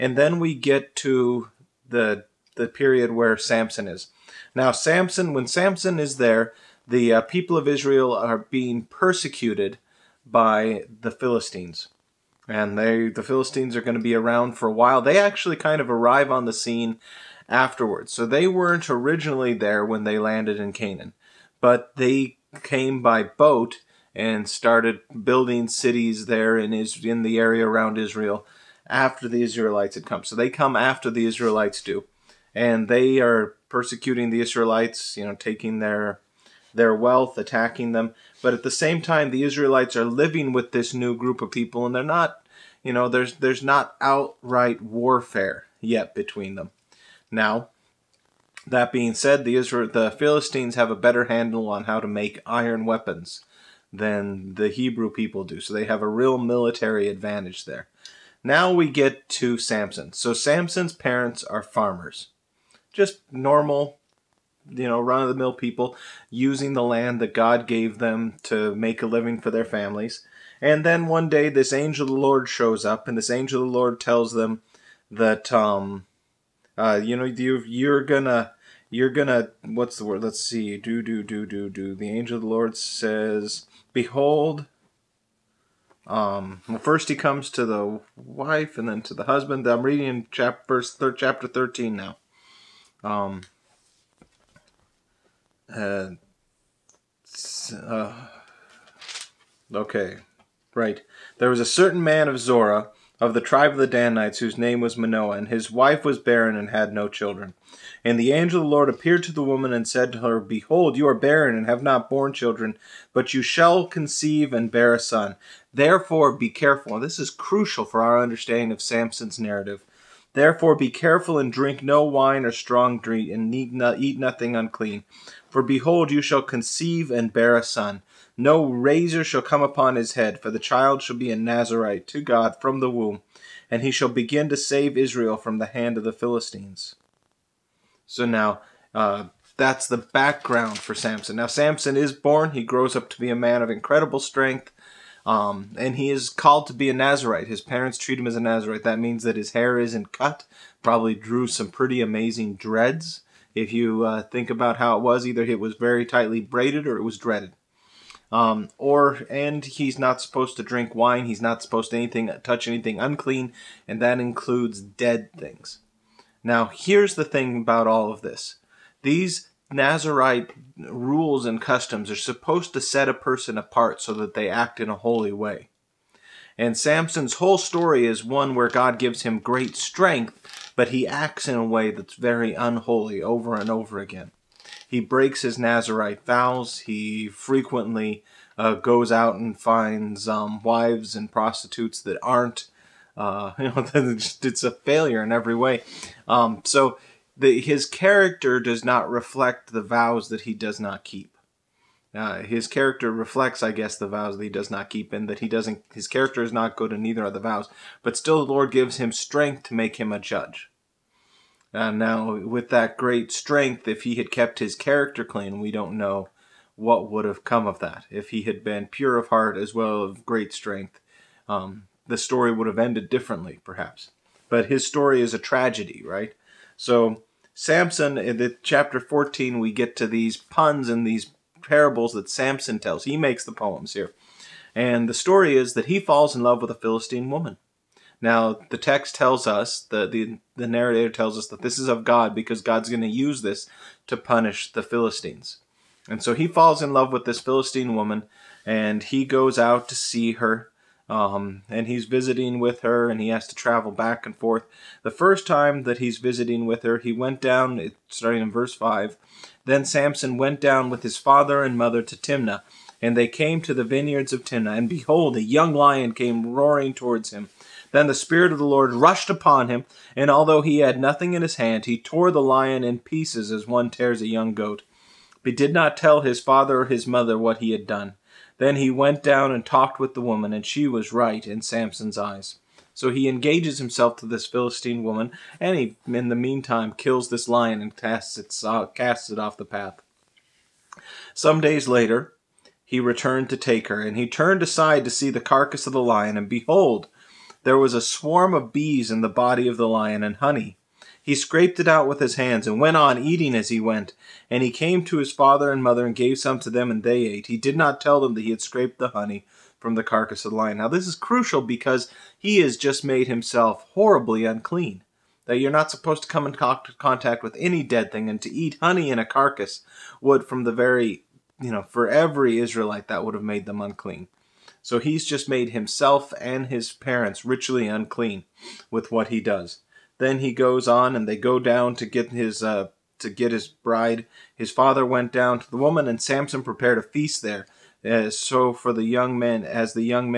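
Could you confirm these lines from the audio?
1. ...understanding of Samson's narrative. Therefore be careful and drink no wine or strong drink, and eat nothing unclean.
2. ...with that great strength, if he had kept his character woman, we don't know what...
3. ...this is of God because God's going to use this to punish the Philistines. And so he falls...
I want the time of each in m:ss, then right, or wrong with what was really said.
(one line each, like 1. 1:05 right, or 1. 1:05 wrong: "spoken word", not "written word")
1. 1:58 right
2. 3:32 wrong: "clean", not "woman"
3. 4:01 right.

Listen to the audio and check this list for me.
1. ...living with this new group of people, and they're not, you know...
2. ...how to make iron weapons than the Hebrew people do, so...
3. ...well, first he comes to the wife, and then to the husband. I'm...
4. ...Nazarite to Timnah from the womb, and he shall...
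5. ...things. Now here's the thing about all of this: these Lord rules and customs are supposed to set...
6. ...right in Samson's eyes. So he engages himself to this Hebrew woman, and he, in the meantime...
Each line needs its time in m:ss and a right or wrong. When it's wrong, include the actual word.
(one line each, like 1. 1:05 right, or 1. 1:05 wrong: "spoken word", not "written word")
1. 0:40 right
2. 0:51 right
3. 1:26 right
4. 2:11 wrong: "God", not "Timnah"
5. 2:45 wrong: "Nazarite", not "Lord"
6. 4:41 wrong: "Philistine", not "Hebrew".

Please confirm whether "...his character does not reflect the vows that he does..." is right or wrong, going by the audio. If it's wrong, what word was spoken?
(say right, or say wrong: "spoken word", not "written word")
right.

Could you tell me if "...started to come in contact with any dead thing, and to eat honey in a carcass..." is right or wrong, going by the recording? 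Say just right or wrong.
wrong.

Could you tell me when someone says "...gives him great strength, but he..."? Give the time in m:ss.
2:58.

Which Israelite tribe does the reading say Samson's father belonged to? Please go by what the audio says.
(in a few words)
the Danites.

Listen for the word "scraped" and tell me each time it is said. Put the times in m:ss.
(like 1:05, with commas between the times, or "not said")
5:01, 5:08.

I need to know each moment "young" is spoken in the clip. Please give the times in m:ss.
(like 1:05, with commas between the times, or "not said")
4:25, 4:34, 5:39.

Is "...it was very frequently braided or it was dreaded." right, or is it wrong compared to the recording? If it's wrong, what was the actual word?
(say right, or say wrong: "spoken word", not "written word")
wrong: "tightly", not "frequently".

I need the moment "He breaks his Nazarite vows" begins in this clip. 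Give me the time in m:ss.
3:04.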